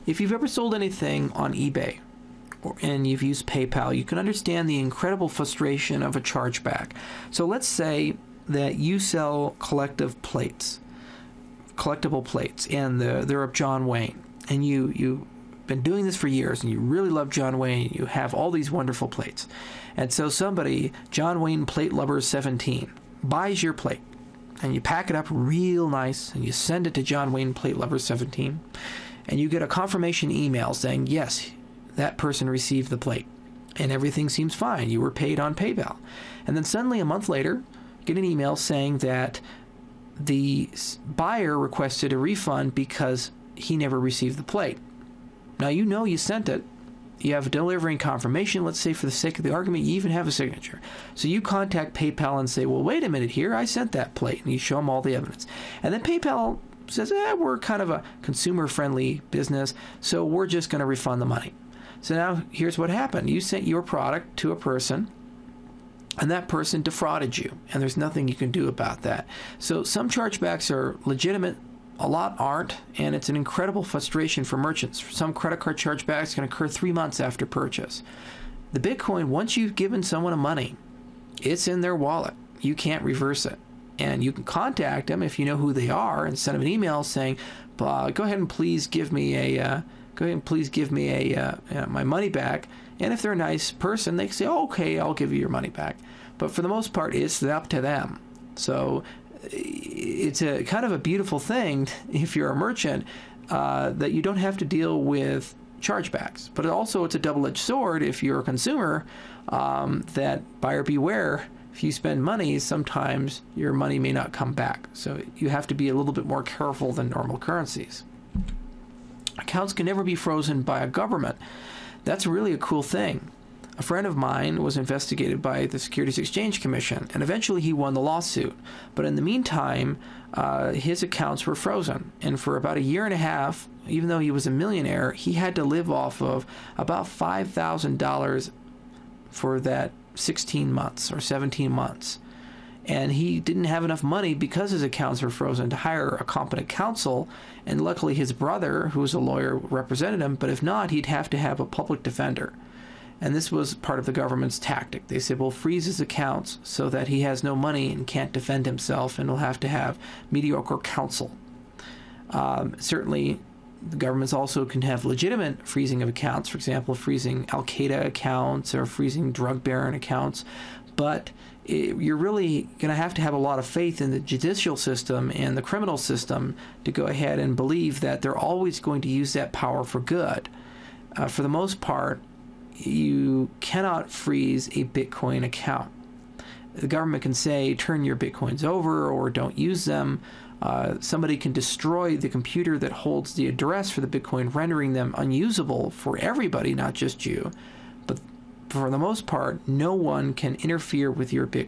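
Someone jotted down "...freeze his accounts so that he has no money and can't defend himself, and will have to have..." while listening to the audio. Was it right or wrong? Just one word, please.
right.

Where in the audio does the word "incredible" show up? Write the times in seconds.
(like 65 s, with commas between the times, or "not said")
4 s, 73 s.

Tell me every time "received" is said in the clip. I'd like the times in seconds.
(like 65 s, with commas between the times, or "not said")
32 s, 43 s.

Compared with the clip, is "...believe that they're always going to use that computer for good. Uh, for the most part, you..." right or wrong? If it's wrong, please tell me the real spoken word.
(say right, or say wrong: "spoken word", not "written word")
wrong: "power", not "computer".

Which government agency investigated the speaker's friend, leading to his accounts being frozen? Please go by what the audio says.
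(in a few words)
Securities Exchange Commission.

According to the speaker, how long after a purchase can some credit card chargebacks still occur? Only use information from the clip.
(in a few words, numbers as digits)
3 months.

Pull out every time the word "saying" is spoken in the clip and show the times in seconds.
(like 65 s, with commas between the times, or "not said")
30 s, 38 s, 87 s.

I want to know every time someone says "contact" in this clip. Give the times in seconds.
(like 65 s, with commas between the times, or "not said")
51 s, 84 s.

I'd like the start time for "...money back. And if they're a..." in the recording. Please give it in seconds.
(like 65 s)
92 s.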